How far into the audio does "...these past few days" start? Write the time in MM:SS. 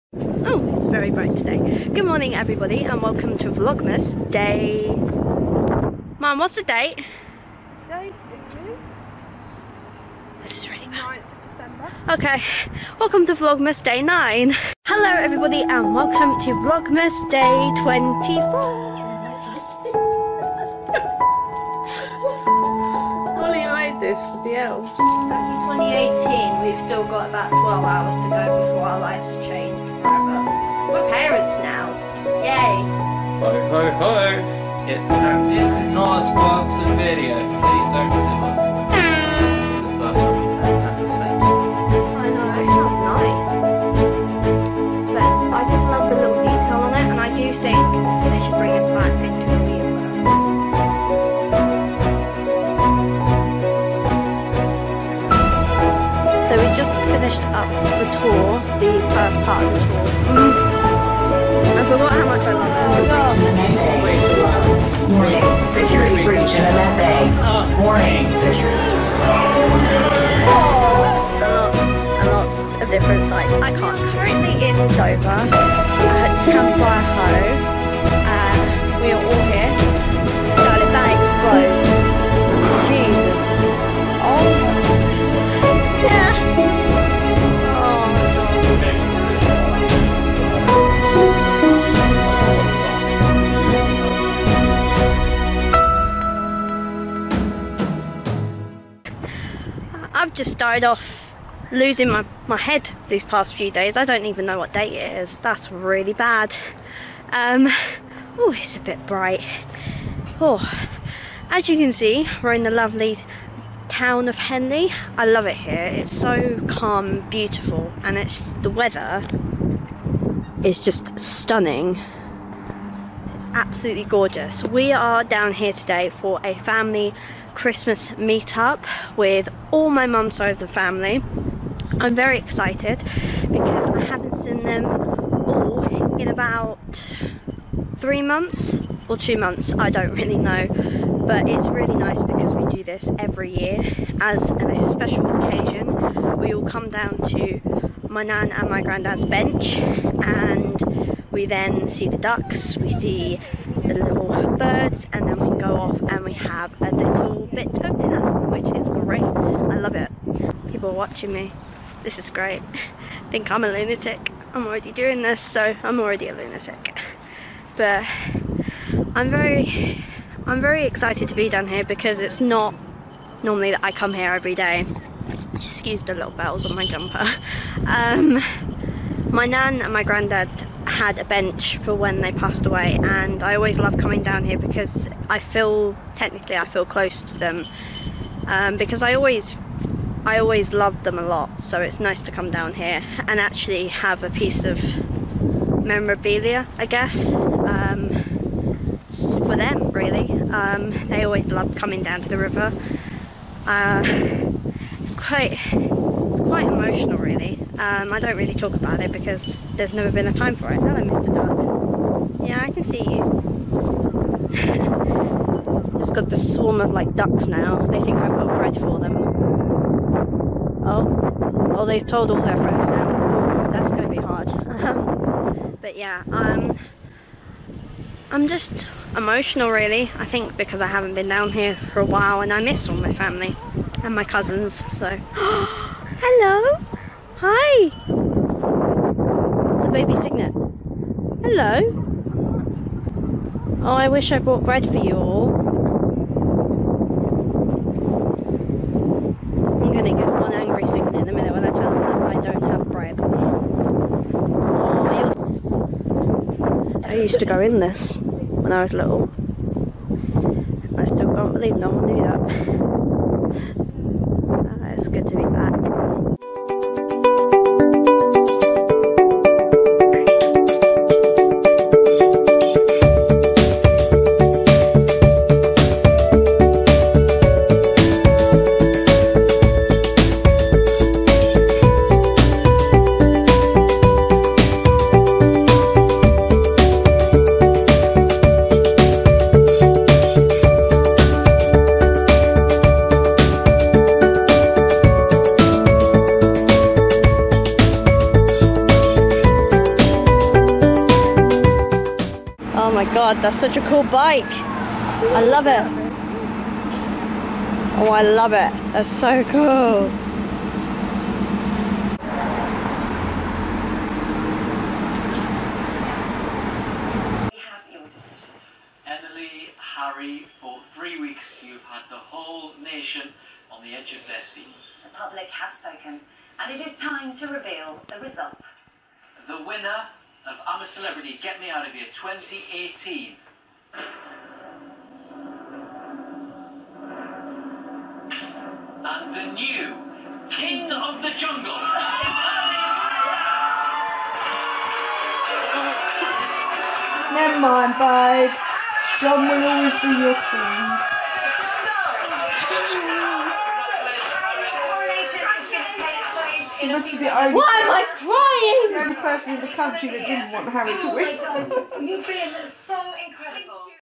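01:43.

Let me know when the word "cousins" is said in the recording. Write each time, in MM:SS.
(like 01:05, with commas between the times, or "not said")
03:54.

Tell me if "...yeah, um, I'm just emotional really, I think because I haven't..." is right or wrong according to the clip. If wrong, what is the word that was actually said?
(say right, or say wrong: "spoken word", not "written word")
right.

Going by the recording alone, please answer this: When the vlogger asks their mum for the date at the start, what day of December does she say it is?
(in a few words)
9th of December.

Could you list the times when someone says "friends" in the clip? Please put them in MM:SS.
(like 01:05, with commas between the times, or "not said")
03:42.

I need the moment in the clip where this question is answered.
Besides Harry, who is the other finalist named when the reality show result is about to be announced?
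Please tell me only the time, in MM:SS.
05:19.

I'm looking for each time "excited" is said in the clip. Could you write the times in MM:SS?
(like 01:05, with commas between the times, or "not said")
02:12, 02:50.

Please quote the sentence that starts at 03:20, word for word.
Um, they always loved coming down to the river.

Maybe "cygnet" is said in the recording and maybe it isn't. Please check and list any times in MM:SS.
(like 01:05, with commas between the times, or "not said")
04:00, 04:10.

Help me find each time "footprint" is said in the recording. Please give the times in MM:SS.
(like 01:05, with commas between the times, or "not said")
not said.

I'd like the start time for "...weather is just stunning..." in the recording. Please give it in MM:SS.
01:58.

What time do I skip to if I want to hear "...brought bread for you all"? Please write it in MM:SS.
04:04.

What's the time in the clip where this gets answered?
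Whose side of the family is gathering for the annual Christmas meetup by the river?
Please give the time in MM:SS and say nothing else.
02:10.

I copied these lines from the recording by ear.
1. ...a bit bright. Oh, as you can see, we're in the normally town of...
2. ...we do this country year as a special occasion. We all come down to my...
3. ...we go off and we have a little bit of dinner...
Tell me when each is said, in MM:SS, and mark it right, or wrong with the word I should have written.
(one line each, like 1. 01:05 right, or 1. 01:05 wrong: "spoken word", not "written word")
1. 01:48 wrong: "lovely", not "normally"
2. 02:22 wrong: "every", not "country"
3. 02:35 right.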